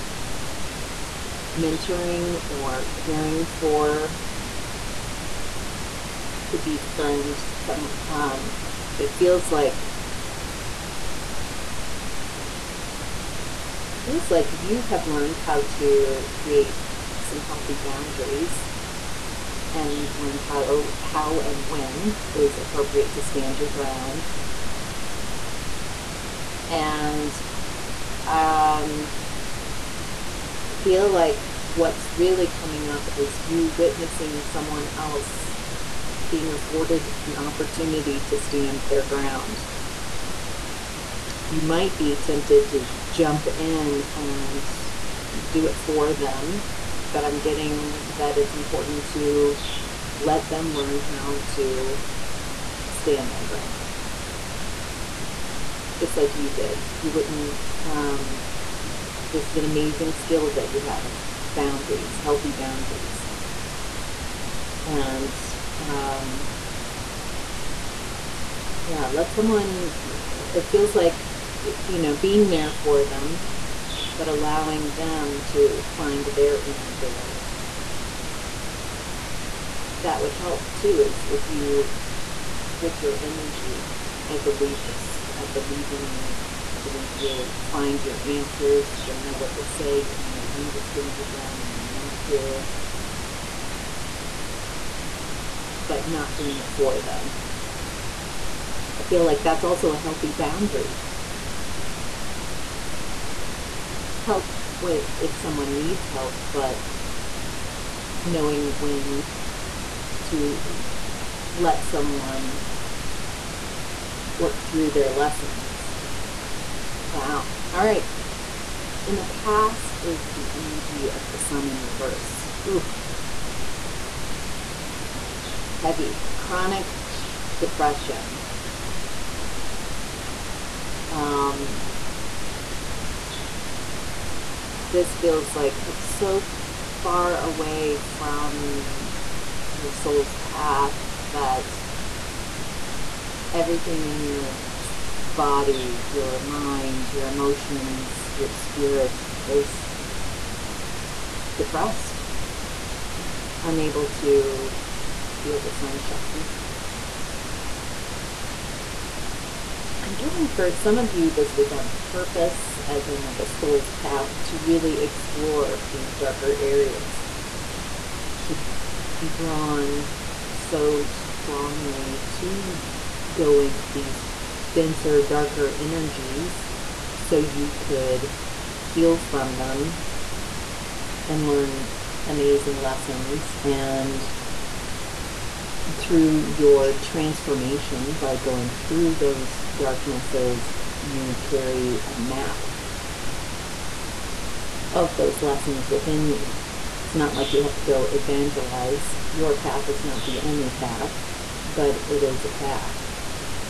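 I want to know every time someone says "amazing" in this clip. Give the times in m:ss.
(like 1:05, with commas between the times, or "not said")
0:59, 3:02.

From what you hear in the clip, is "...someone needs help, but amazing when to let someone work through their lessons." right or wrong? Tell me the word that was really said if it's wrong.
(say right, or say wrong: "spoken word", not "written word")
wrong: "knowing", not "amazing".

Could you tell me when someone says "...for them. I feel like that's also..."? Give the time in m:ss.
1:36.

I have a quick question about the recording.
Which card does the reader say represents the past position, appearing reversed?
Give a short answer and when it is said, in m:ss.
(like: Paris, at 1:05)
the sun, at 2:01.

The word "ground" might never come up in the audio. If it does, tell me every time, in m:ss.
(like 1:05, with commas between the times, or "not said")
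0:23, 0:39, 0:53, 1:31.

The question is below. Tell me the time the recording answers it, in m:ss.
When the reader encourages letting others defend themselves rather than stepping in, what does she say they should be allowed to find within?
1:16.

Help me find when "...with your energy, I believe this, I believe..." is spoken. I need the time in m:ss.
1:22.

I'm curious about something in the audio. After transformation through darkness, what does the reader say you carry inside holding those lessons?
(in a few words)
a map.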